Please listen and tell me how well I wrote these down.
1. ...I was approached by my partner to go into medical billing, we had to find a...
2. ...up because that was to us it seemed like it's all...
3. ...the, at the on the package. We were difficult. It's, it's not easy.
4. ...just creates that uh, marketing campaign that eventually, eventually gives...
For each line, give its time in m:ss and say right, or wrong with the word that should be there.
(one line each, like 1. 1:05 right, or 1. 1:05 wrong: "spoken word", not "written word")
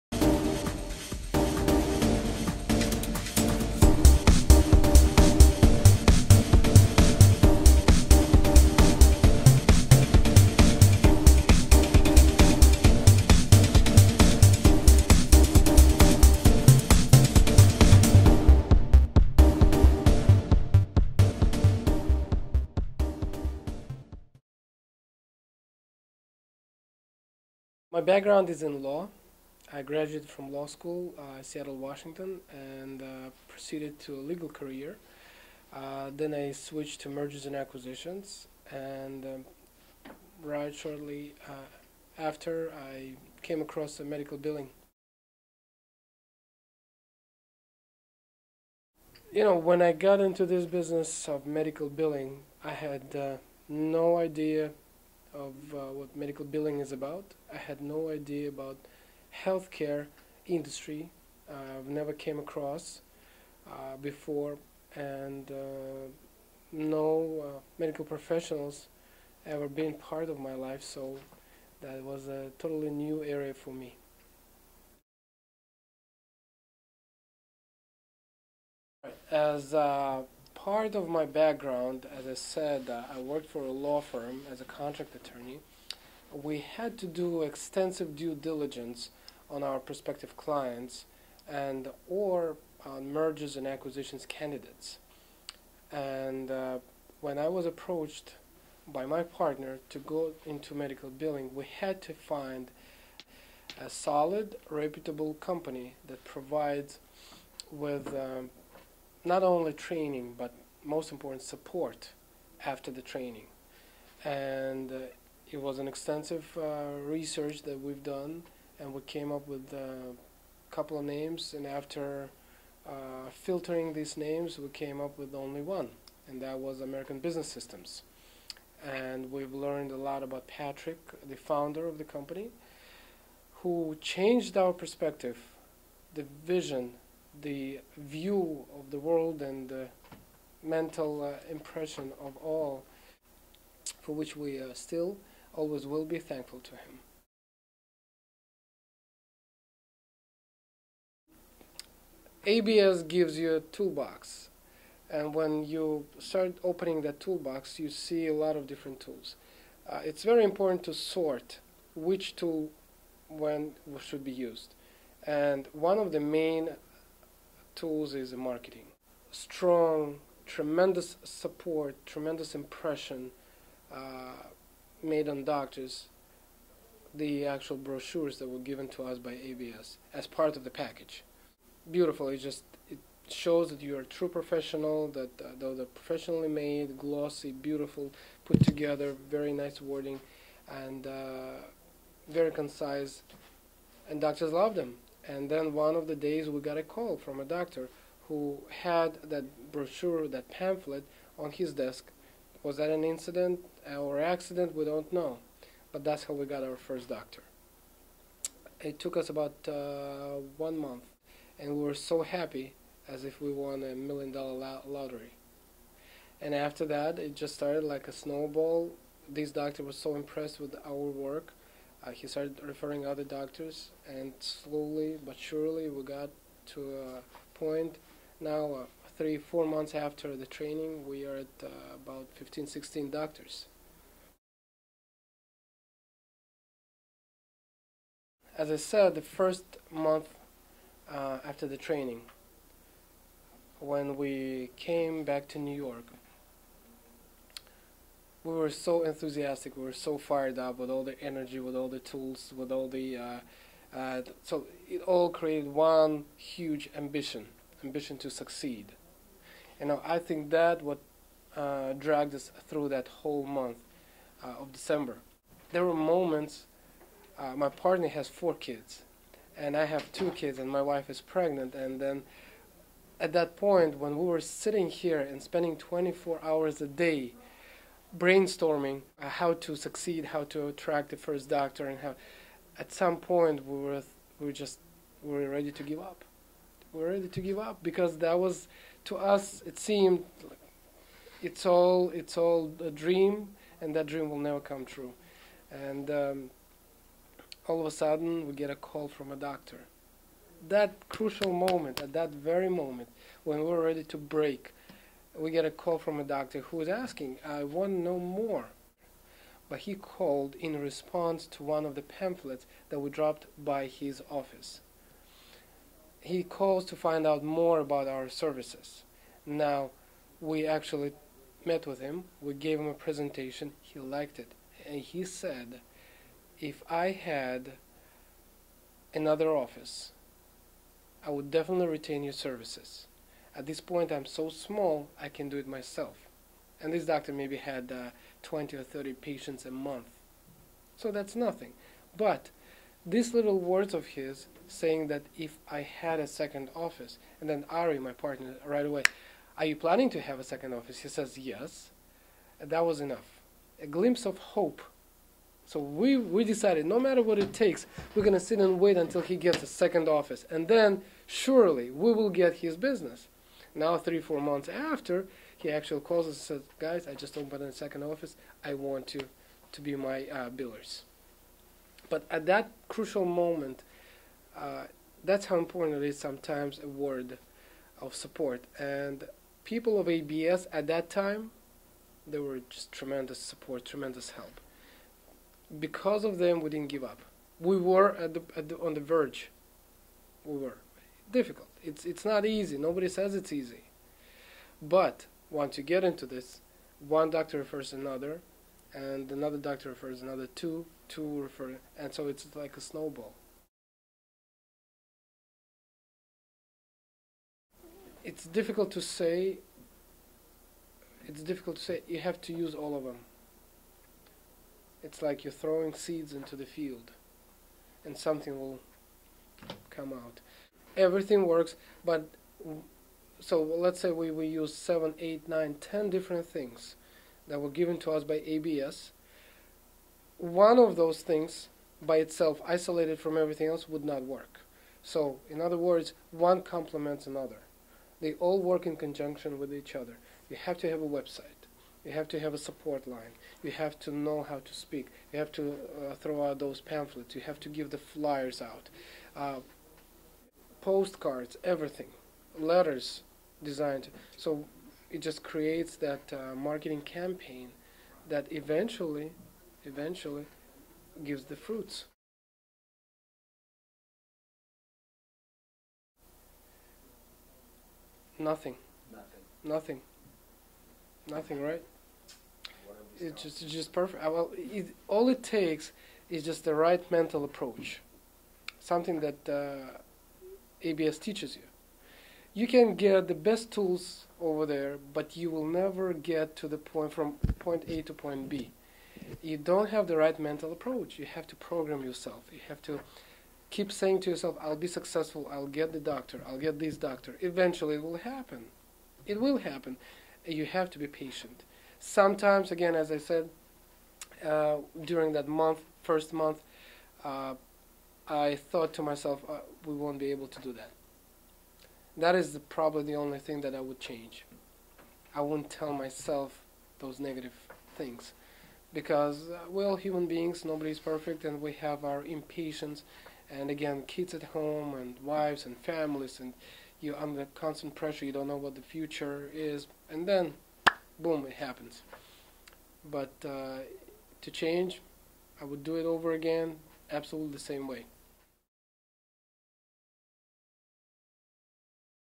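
1. 1:37 right
2. 4:47 right
3. 6:28 wrong: "verge", not "package"
4. 7:35 right.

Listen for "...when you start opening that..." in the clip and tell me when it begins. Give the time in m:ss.
2:35.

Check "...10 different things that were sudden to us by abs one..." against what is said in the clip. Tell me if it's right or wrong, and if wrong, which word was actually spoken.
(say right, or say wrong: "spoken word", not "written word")
wrong: "given", not "sudden".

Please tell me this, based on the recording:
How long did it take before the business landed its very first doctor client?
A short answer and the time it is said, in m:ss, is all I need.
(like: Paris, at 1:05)
One month, at 3:30.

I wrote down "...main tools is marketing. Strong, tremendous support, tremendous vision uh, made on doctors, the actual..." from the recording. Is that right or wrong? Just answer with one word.
wrong.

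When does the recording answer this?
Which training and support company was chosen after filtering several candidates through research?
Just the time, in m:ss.
2:06.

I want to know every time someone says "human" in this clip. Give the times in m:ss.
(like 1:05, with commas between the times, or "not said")
8:39.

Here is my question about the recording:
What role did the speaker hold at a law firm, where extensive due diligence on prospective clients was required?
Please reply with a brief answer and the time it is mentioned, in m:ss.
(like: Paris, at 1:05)
Contract attorney, at 1:24.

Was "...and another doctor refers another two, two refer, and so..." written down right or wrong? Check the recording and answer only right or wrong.
right.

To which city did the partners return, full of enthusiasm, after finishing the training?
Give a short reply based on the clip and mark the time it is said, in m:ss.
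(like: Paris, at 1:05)
New York, at 4:05.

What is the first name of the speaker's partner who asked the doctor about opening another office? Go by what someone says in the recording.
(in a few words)
Ari.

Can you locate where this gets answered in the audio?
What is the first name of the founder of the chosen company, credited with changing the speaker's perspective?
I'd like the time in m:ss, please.
2:10.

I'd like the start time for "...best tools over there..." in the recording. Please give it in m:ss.
8:03.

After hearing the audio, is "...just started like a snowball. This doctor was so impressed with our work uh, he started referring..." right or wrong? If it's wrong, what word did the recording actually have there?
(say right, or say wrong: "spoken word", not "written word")
right.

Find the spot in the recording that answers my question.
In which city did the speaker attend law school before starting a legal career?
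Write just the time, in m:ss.
0:31.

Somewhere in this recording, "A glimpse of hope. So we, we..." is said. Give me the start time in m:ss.
5:53.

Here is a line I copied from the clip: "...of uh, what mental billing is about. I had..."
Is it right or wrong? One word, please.
wrong.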